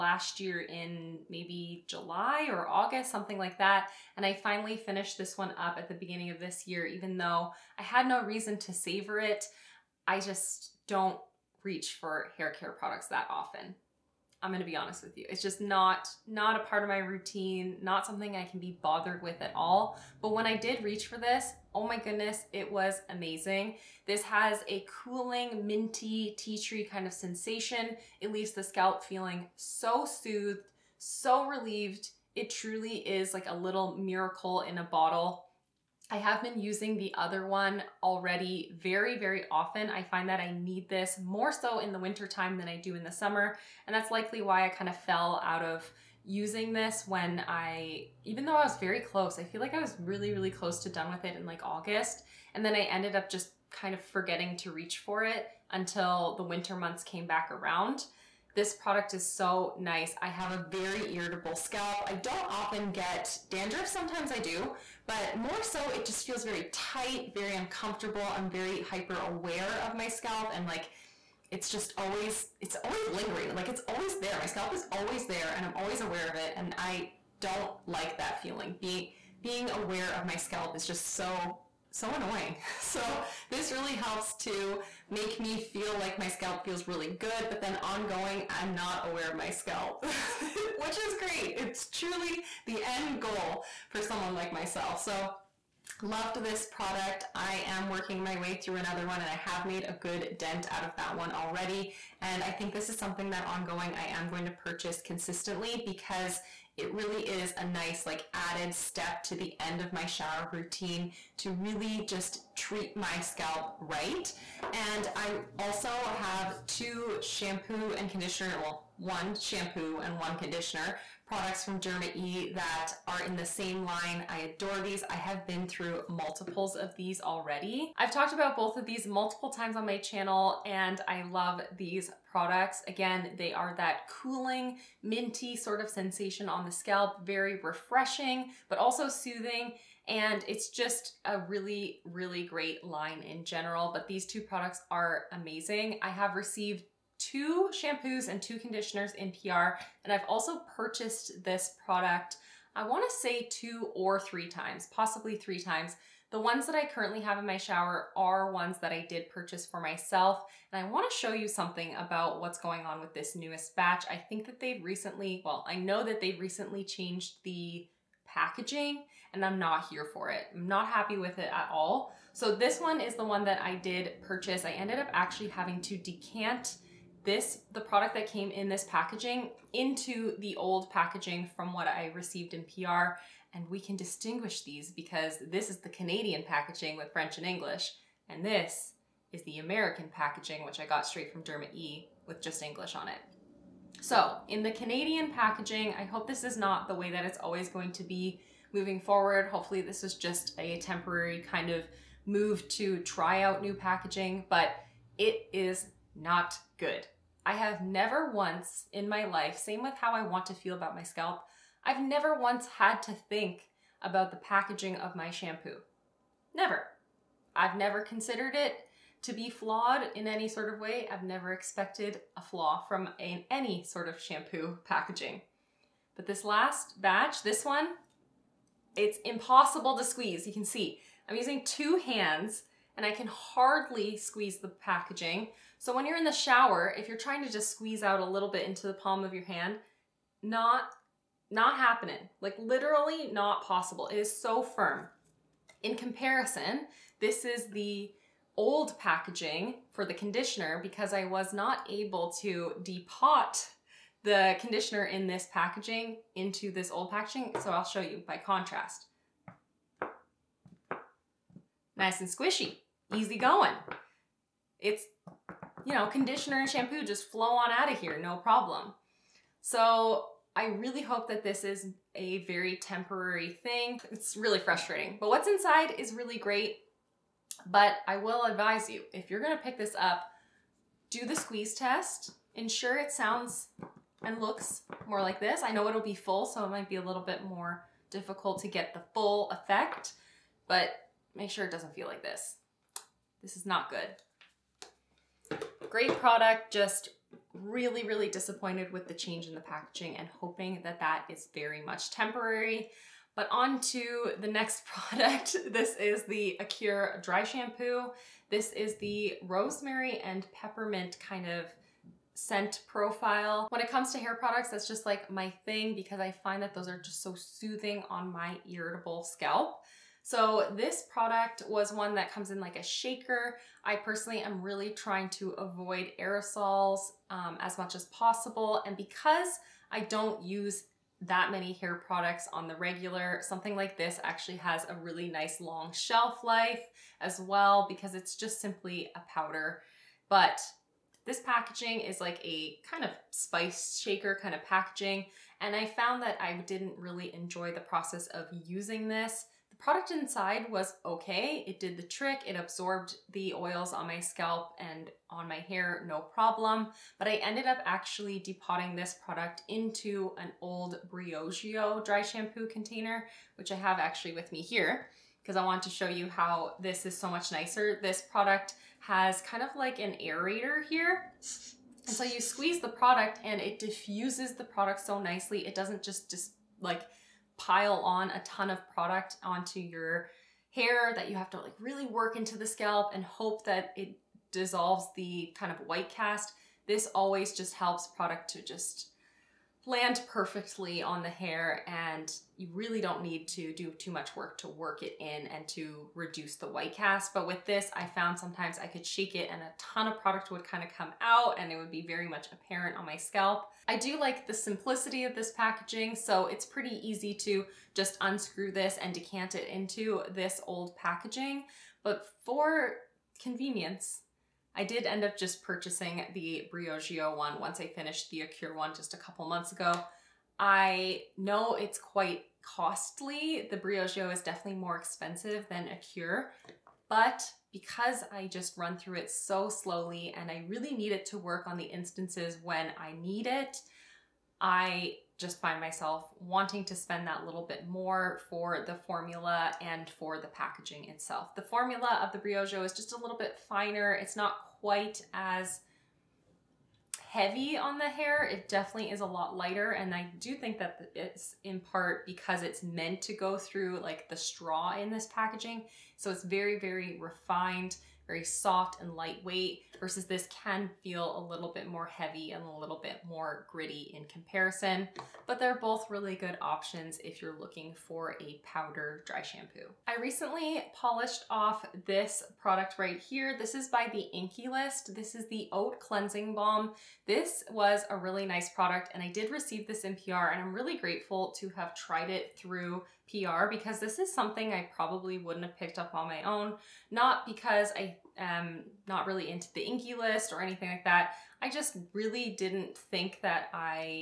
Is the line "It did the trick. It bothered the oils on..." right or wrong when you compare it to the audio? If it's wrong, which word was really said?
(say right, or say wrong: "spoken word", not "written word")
wrong: "absorbed", not "bothered".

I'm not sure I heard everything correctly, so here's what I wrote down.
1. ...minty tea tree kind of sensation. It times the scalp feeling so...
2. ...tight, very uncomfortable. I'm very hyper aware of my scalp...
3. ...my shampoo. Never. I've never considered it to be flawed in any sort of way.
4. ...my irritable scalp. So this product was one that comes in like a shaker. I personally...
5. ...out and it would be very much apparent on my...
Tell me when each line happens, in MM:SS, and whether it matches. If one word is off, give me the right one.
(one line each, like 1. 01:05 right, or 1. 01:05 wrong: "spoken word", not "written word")
1. 00:25 wrong: "leaves", not "times"
2. 01:06 right
3. 03:35 right
4. 05:18 right
5. 06:41 right.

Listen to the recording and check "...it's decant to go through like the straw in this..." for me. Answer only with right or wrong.
wrong.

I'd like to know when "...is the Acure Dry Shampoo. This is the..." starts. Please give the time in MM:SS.
05:05.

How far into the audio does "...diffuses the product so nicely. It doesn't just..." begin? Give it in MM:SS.
06:13.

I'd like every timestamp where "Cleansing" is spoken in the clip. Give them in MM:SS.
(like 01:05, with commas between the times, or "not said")
07:56.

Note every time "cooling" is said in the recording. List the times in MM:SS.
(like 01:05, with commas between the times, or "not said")
00:25, 02:14.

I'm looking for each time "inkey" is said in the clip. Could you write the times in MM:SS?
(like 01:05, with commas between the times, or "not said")
07:54, 08:09.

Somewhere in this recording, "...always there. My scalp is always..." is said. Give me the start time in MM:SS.
01:13.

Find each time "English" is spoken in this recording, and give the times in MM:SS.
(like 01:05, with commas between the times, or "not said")
03:07, 03:12.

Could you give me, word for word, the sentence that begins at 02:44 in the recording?
I think that they've recently, well, I know that they've recently changed the packaging, and I'm not here for it.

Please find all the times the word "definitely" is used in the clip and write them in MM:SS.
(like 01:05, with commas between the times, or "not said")
07:04, 07:28.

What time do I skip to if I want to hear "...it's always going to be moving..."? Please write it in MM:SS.
03:17.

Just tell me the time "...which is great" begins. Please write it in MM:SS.
01:30.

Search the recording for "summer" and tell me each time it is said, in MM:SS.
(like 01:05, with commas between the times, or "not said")
00:43.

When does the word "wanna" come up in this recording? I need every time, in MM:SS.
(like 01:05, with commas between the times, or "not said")
02:32, 02:40.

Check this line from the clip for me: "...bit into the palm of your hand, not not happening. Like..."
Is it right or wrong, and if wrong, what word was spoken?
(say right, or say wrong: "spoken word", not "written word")
right.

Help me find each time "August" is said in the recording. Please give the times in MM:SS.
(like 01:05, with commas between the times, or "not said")
00:02, 00:51.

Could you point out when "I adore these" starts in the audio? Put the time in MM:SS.
02:04.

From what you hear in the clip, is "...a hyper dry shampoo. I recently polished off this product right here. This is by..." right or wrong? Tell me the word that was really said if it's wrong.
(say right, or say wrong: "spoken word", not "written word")
wrong: "powder", not "hyper".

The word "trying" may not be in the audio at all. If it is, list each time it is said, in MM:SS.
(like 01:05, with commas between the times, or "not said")
03:57, 05:24.